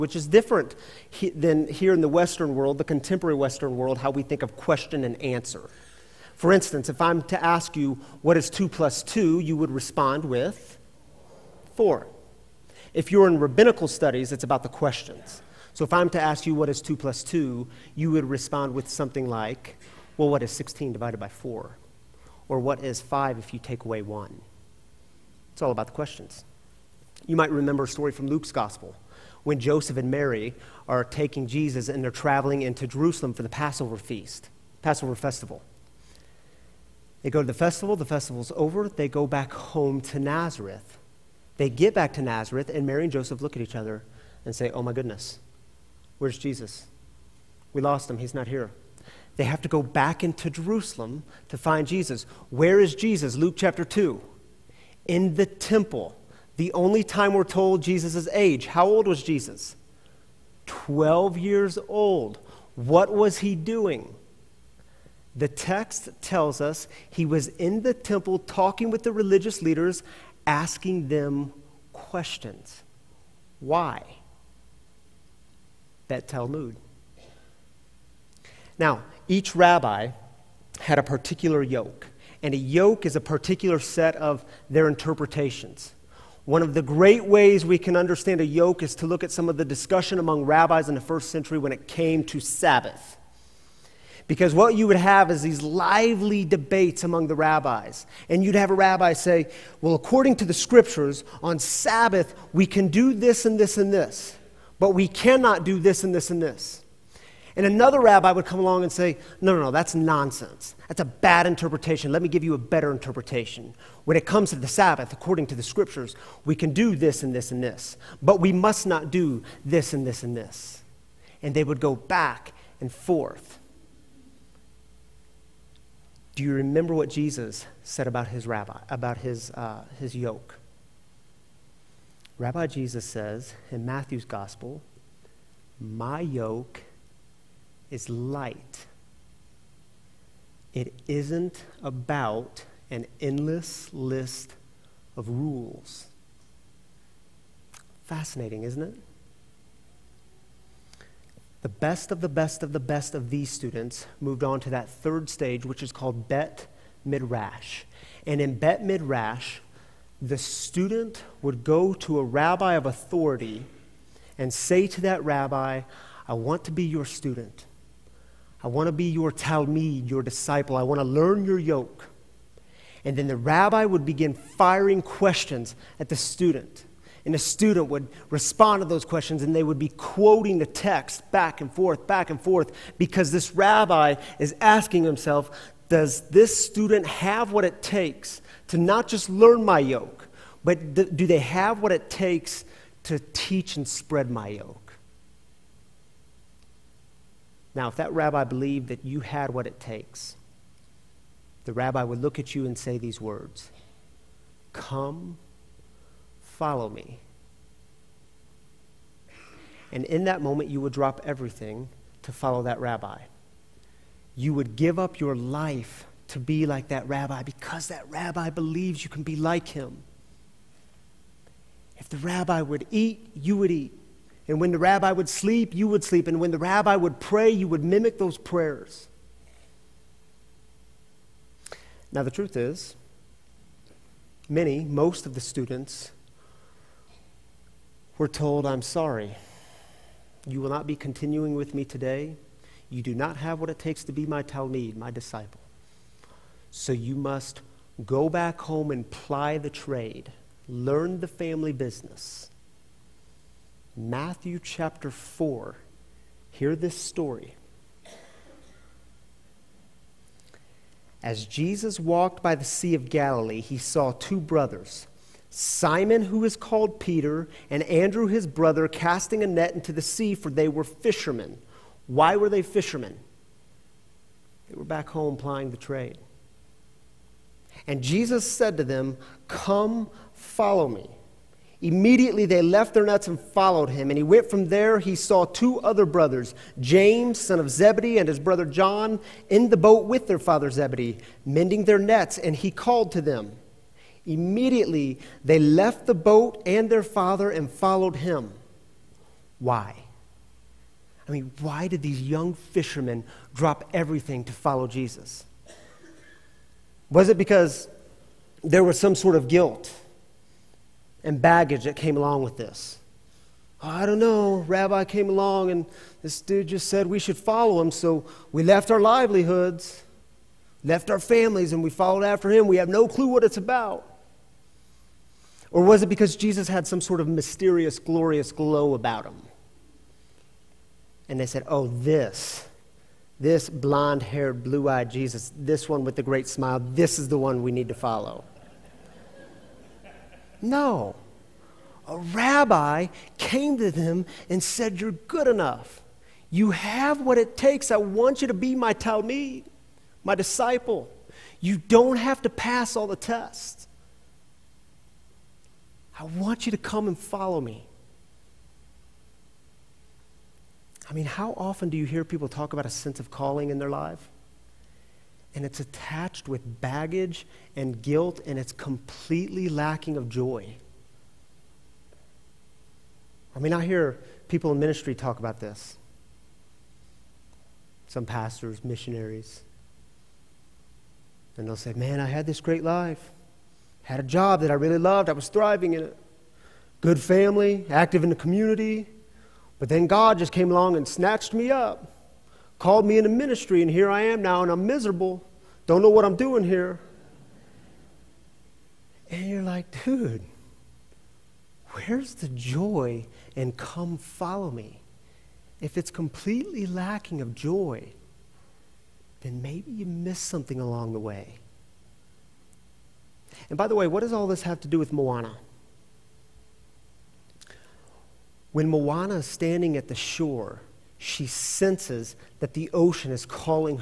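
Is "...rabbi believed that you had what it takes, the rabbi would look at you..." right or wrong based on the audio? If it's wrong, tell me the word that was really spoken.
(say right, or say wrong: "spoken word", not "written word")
right.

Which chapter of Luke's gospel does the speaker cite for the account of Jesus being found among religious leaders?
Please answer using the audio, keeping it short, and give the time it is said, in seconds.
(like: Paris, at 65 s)
Chapter 2, at 53 s.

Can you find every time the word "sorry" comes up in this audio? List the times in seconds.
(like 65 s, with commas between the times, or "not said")
238 s.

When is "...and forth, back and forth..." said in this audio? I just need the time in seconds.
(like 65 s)
181 s.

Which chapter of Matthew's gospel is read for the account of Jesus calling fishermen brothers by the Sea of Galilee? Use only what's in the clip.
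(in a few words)
Chapter 4.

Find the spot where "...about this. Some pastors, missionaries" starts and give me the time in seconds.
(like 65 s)
375 s.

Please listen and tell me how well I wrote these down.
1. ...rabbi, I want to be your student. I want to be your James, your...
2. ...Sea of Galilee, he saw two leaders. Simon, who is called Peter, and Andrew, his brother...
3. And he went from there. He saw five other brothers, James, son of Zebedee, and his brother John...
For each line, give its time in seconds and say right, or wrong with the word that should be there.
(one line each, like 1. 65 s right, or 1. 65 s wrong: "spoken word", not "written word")
1. 165 s wrong: "Talmud", not "James"
2. 262 s wrong: "brothers", not "leaders"
3. 284 s wrong: "two", not "five".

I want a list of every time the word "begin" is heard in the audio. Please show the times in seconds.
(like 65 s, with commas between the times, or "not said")
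174 s.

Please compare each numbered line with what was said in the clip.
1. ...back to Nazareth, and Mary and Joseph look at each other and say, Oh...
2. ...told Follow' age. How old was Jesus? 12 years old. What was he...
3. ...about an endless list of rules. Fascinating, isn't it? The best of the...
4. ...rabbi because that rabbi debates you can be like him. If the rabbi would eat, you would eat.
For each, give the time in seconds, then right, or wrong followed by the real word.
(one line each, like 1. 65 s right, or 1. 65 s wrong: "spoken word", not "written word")
1. 41 s right
2. 57 s wrong: "Jesus", not "Follow"
3. 141 s right
4. 217 s wrong: "believes", not "debates".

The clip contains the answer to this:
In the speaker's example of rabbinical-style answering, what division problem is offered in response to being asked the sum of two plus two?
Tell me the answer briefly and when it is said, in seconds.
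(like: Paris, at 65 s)
16 divided by 4, at 20 s.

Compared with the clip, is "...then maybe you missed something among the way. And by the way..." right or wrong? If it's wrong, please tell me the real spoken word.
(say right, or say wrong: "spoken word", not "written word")
wrong: "along", not "among".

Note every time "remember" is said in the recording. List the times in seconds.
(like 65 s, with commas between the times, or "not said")
27 s, 126 s.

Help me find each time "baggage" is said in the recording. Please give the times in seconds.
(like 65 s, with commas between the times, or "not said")
311 s, 366 s.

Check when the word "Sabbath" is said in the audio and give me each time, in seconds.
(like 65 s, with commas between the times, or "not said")
92 s, 101 s, 114 s.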